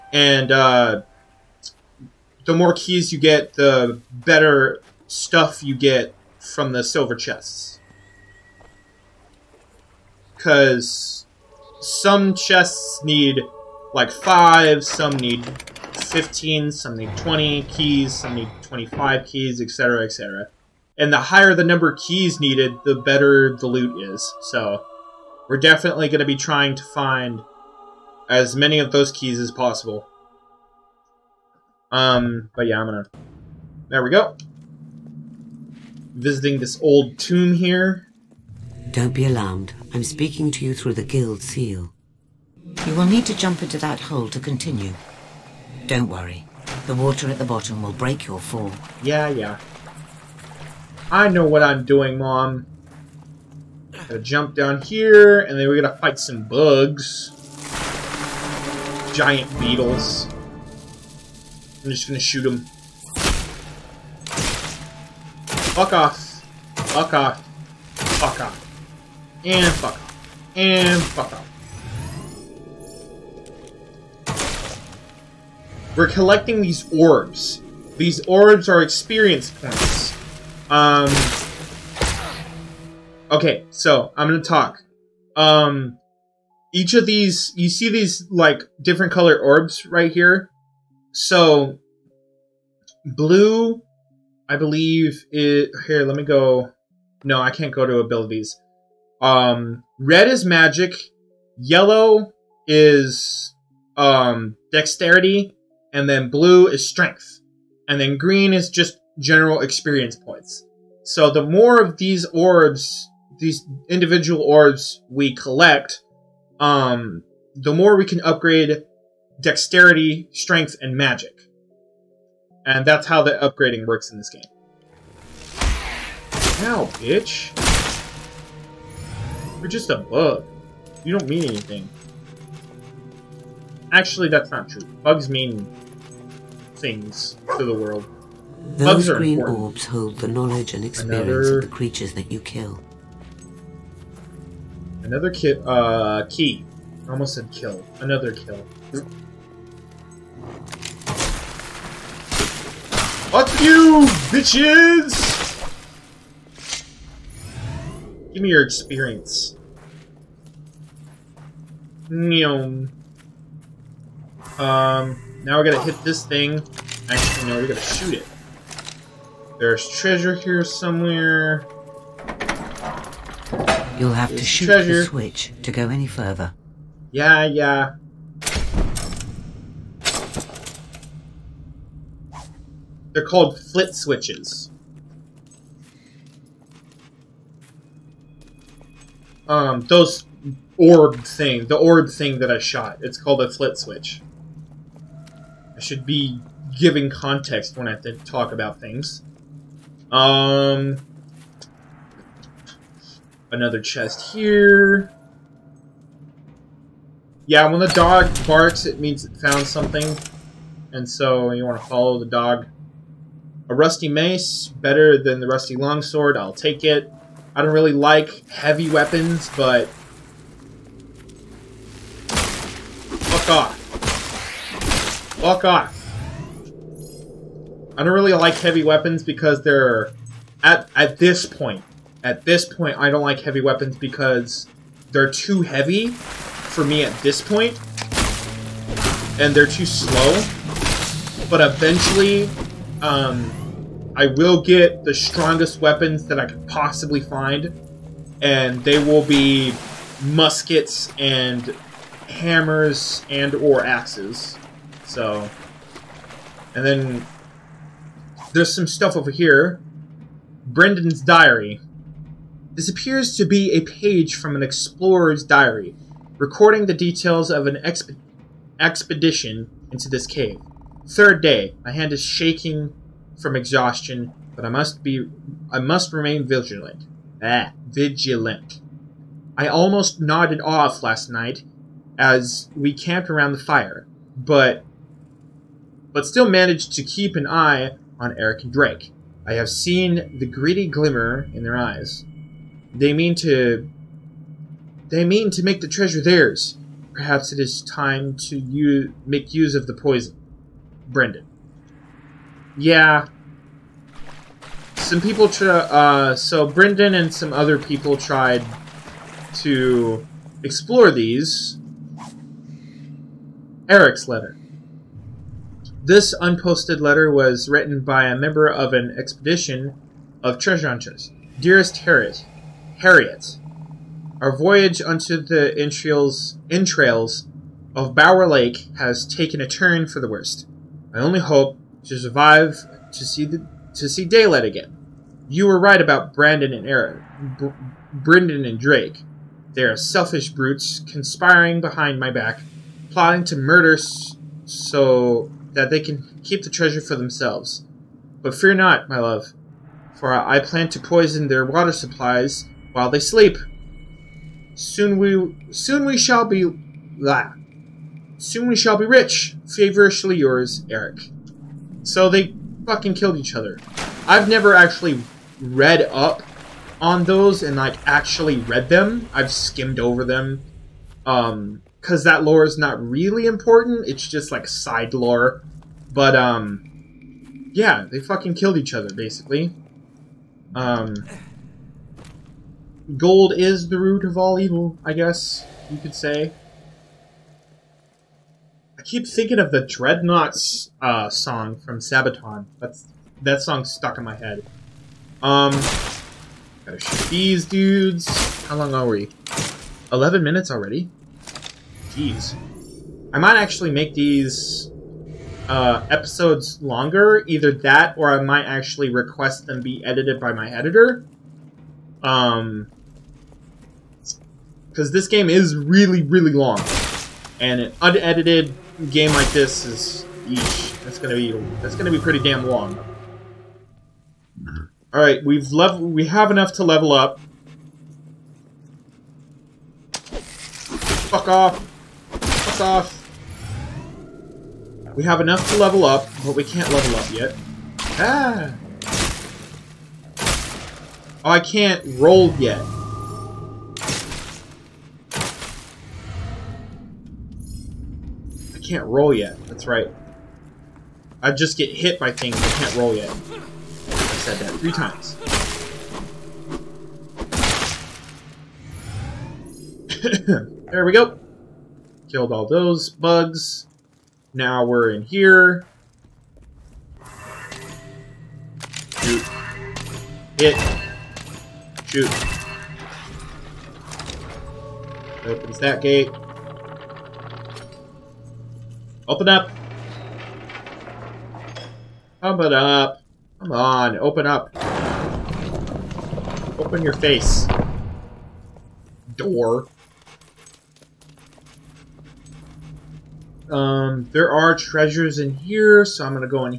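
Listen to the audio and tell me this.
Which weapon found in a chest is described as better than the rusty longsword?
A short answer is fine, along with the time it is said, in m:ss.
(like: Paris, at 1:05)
Rusty mace, at 3:33.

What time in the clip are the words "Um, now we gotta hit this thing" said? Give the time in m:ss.
2:44.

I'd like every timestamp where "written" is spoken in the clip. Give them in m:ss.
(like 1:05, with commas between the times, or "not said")
5:17.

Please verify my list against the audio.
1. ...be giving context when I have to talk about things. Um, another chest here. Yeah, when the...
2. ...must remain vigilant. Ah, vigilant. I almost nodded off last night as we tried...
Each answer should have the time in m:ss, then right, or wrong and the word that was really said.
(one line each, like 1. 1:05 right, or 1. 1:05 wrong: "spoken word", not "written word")
1. 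3:16 right
2. 4:35 wrong: "camped", not "tried".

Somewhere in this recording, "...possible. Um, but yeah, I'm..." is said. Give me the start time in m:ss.
0:29.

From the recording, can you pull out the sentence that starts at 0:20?
And the higher the number of keys needed, the better the loot is.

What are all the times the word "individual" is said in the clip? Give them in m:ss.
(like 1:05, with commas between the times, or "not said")
1:53.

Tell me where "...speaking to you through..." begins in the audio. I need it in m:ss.
0:40.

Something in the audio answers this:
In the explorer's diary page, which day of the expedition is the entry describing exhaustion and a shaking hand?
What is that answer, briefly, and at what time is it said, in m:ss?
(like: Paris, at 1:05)
Third day, at 4:31.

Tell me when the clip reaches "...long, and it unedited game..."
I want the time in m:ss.
6:56.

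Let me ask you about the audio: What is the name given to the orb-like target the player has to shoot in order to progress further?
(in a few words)
Flit switch.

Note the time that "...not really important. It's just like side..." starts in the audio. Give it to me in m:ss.
6:12.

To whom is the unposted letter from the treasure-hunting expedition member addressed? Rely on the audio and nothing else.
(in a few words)
Harriet.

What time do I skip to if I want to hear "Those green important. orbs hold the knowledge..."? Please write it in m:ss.
2:18.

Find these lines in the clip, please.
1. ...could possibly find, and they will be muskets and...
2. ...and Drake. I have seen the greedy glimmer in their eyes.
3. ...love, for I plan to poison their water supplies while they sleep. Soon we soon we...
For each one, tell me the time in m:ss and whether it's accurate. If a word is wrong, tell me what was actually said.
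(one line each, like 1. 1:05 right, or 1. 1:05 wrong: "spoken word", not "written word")
1. 4:06 right
2. 4:48 right
3. 5:49 right.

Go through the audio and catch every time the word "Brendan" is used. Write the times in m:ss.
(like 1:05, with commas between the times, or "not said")
4:20, 5:01, 5:06, 5:38.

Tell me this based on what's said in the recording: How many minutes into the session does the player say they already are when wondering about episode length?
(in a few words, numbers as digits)
11.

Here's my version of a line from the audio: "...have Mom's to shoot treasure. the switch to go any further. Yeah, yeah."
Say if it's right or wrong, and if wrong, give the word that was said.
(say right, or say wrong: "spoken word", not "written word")
wrong: "There", not "Mom".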